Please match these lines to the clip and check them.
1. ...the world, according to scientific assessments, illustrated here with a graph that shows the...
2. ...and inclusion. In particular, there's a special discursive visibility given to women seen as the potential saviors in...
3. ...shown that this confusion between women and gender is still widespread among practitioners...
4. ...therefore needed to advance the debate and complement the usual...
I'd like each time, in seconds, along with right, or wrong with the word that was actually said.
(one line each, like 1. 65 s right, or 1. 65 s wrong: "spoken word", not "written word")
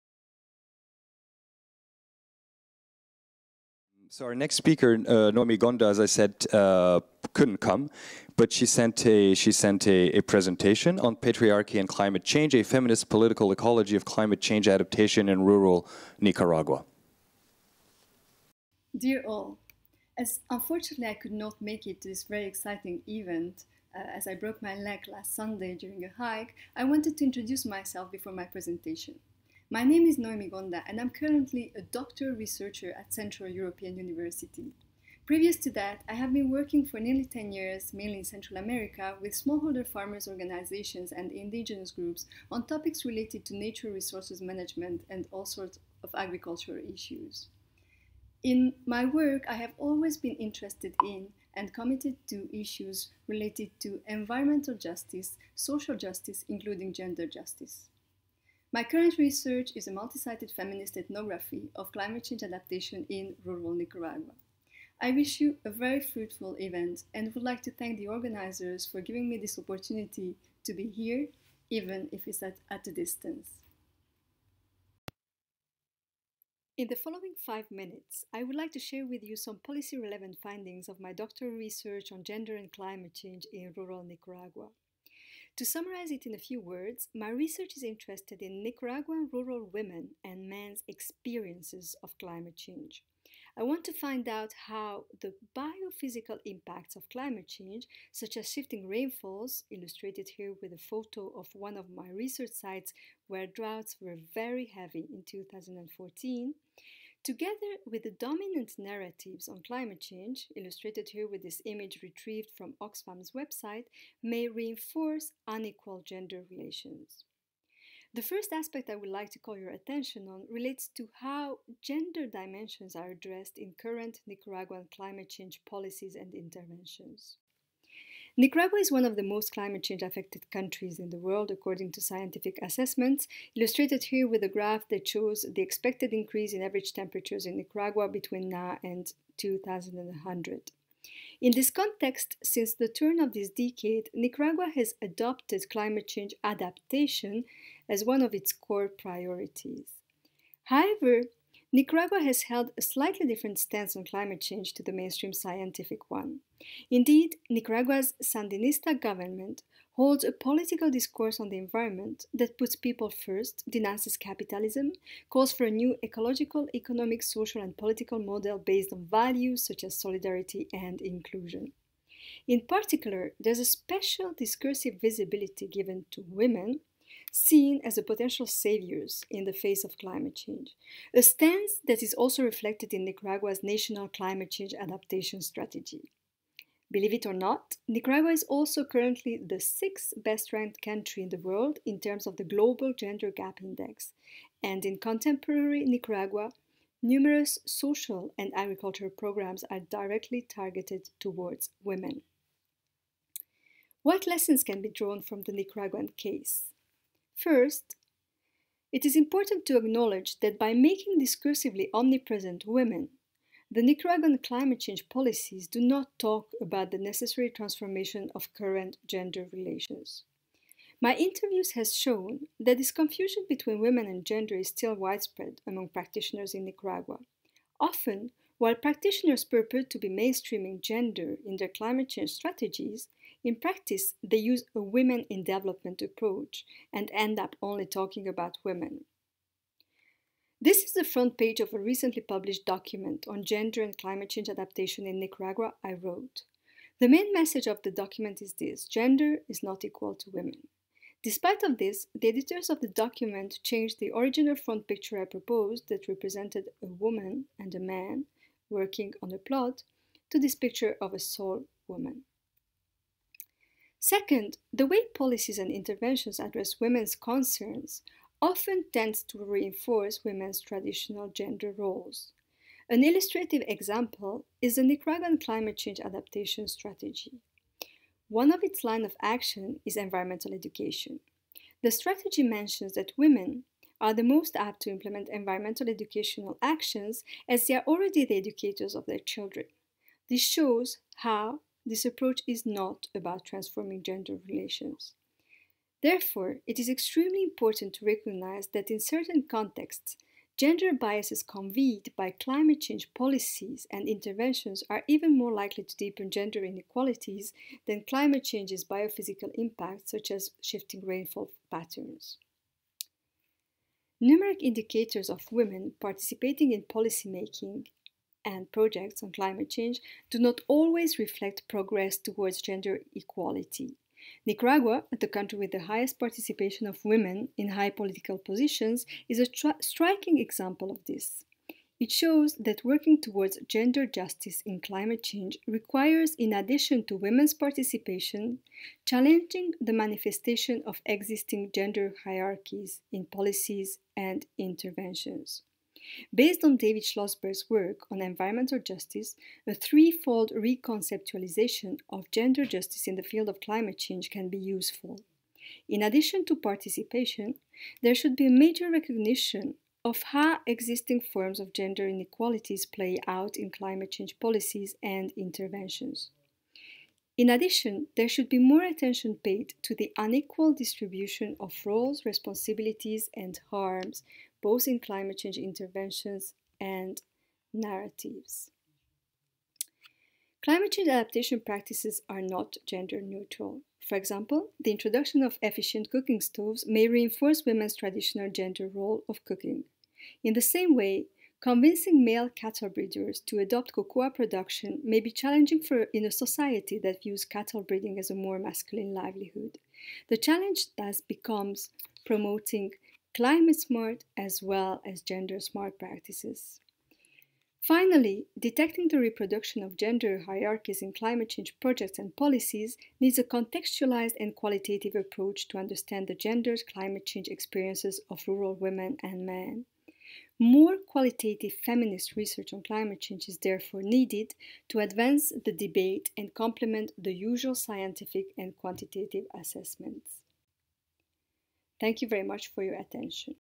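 1. 131 s right
2. 170 s right
3. 221 s right
4. 423 s right.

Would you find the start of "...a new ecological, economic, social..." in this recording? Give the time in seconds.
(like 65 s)
165 s.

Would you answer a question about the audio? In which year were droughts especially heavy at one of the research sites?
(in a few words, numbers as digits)
2014.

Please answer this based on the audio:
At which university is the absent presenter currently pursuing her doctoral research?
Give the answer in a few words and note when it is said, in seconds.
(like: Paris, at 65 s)
Central European University, at 33 s.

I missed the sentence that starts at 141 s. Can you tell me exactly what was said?
In this context, since the turn of this decade, Nicaragua has adopted climate change adaptation as one of its core priorities.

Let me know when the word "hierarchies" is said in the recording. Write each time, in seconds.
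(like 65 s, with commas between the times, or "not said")
342 s, 410 s.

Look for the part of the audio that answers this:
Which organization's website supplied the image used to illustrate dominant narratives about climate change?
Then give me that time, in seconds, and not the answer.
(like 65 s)
112 s.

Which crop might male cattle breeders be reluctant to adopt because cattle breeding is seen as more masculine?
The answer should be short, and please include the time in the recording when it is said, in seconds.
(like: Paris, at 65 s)
Cocoa, at 393 s.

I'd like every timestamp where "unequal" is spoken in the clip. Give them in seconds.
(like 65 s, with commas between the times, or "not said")
115 s, 370 s.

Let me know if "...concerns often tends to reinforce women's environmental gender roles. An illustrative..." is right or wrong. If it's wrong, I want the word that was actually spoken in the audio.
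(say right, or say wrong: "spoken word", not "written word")
wrong: "traditional", not "environmental".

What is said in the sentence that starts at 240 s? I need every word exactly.
This is the front page of a recently published document on gender and climate change adaptation in Nicaragua I wrote.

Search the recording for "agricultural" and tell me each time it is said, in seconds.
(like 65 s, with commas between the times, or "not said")
46 s, 198 s.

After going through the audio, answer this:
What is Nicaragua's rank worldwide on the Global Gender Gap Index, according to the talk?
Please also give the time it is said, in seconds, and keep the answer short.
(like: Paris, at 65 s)
6th, at 189 s.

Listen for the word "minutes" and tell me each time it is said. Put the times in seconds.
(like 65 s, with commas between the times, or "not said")
77 s.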